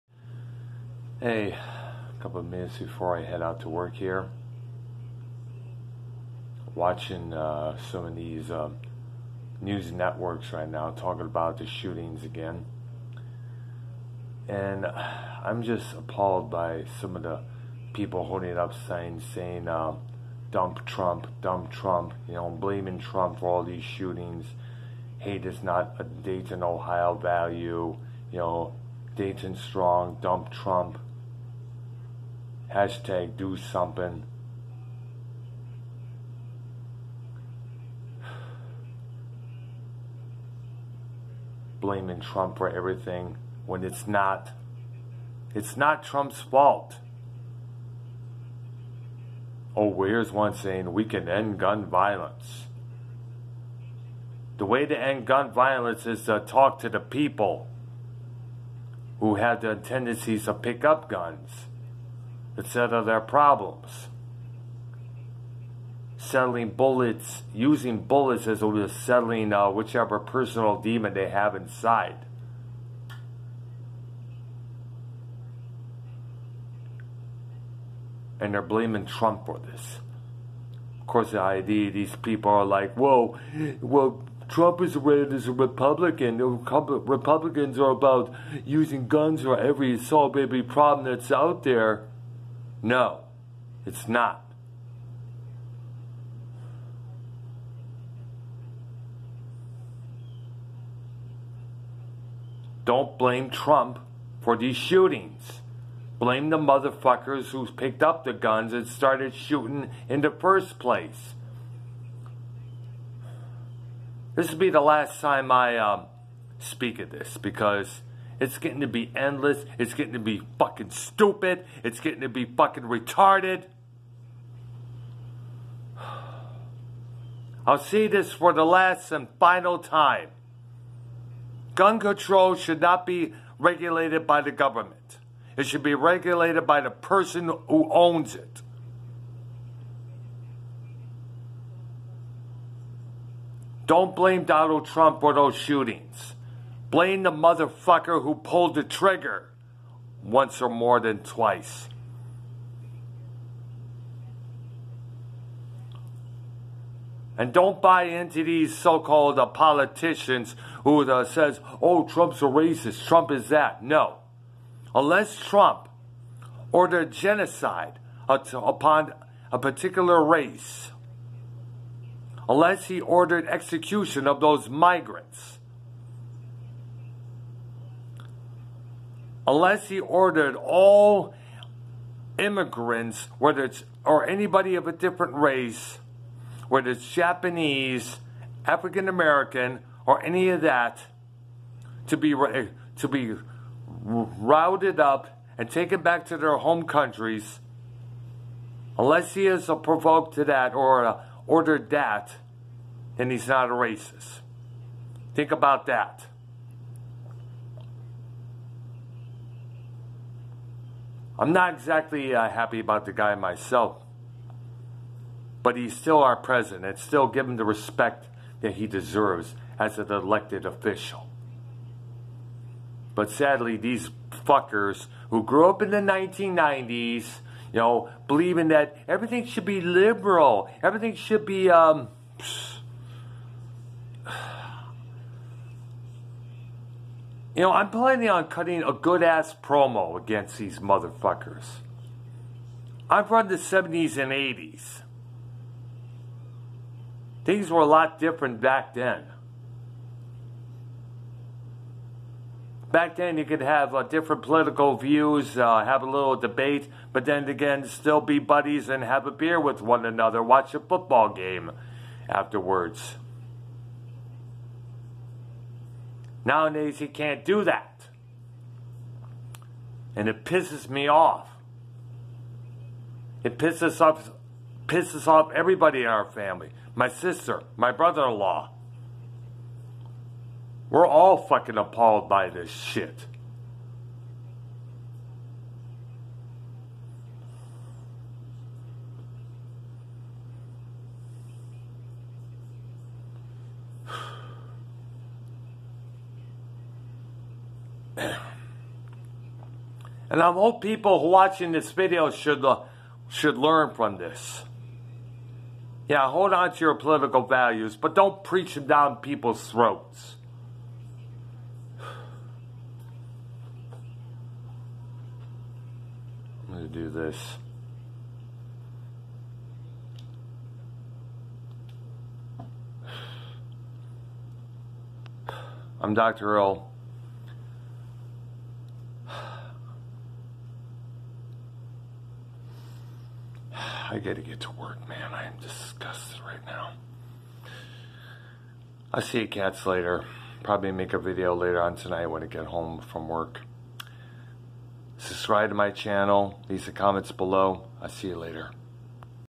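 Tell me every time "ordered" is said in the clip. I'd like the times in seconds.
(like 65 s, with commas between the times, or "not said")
166 s, 172 s, 179 s, 201 s.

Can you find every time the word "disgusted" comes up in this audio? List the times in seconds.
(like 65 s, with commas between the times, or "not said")
335 s.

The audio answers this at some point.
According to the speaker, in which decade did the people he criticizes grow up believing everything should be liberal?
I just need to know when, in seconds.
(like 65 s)
225 s.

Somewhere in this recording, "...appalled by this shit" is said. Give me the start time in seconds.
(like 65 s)
281 s.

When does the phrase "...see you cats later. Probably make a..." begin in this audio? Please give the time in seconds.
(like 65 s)
339 s.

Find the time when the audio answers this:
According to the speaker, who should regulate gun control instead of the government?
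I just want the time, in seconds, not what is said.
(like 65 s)
136 s.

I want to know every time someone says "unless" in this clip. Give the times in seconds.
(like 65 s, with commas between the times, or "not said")
164 s, 172 s, 179 s, 198 s.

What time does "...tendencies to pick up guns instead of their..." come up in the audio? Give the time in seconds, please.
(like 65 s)
59 s.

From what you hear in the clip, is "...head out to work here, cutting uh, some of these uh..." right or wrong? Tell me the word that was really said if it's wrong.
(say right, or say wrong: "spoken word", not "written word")
wrong: "watching", not "cutting".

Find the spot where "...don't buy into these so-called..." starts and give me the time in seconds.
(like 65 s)
157 s.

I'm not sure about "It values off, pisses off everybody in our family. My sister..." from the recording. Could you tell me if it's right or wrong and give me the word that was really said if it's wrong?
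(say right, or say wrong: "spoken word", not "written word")
wrong: "pisses", not "values".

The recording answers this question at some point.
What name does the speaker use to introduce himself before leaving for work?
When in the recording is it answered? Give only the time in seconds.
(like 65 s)
326 s.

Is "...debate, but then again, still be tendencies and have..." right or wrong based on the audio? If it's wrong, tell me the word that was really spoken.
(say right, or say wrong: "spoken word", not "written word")
wrong: "buddies", not "tendencies".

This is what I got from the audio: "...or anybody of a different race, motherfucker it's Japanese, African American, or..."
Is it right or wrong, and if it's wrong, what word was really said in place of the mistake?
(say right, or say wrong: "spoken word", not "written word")
wrong: "whether", not "motherfucker".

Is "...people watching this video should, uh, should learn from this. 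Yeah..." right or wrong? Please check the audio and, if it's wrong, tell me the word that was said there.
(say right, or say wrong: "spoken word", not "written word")
right.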